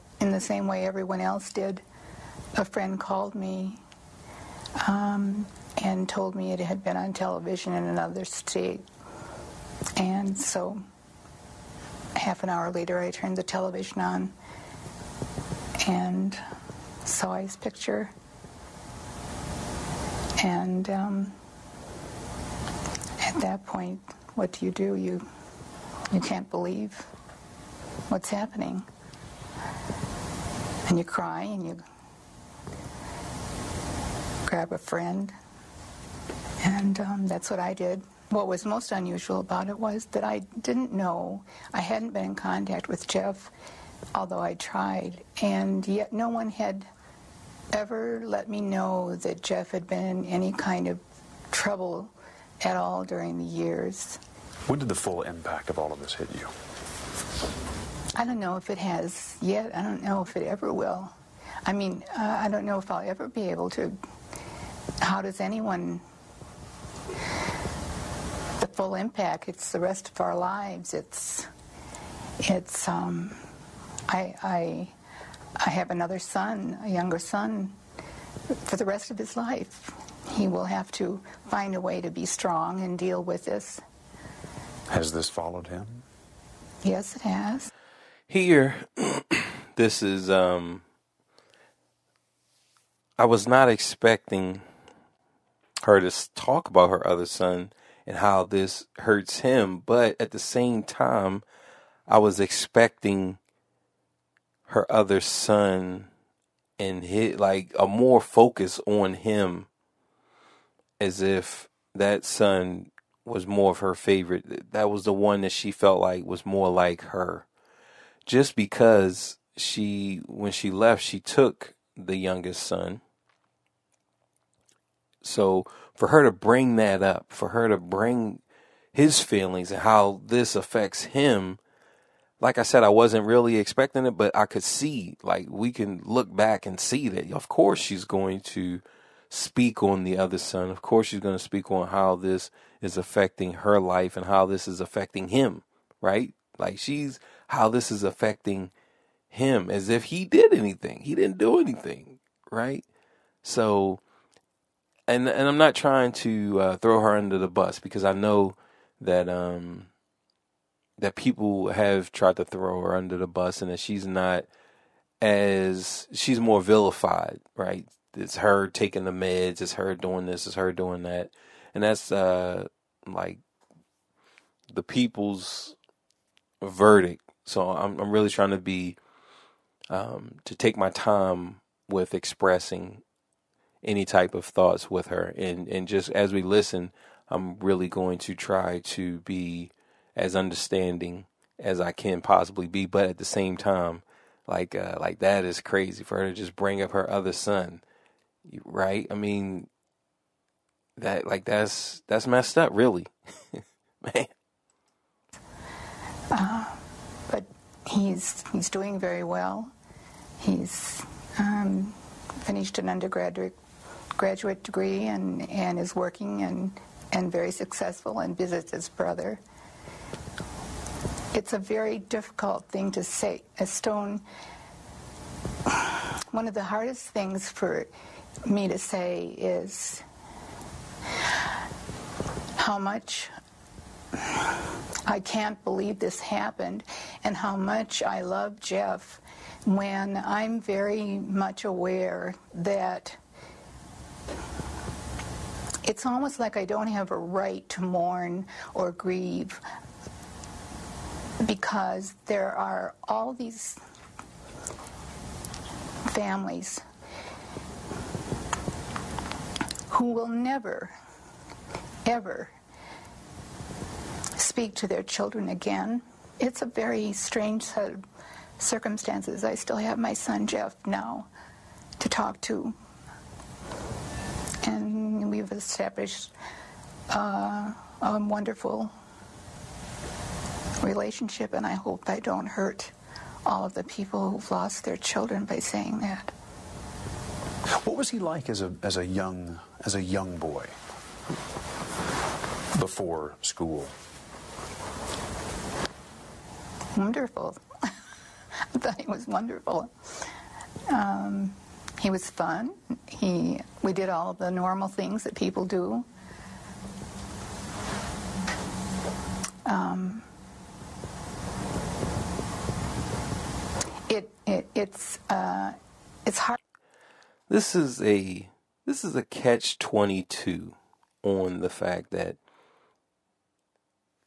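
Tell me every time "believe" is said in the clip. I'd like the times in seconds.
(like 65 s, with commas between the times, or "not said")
26 s, 235 s.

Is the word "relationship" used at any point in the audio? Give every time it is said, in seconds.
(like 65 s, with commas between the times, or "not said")
280 s.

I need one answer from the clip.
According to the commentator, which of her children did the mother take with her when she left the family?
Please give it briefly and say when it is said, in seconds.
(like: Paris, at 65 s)
the youngest son, at 121 s.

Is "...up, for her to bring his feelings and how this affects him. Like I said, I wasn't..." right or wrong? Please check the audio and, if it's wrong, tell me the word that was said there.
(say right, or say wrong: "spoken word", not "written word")
right.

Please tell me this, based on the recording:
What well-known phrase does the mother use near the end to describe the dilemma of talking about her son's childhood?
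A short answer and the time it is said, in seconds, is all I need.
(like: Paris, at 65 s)
catch-22, at 319 s.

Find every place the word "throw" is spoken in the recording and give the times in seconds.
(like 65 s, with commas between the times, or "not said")
156 s, 162 s.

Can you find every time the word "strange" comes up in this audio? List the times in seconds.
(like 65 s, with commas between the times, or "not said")
267 s.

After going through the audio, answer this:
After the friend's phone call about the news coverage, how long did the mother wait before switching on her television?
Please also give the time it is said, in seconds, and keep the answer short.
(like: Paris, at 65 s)
half an hour, at 12 s.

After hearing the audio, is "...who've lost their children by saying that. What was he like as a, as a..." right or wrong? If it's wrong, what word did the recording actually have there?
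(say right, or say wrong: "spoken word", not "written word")
right.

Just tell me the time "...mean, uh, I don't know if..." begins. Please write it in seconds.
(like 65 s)
61 s.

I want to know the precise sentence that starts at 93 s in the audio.
I was not expecting her to talk about her other son and how this hurts him.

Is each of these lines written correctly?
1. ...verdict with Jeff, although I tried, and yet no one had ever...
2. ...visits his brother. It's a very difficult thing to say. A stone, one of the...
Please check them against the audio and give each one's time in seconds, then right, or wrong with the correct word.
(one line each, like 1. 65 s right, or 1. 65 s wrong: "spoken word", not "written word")
1. 42 s wrong: "contact", not "verdict"
2. 218 s right.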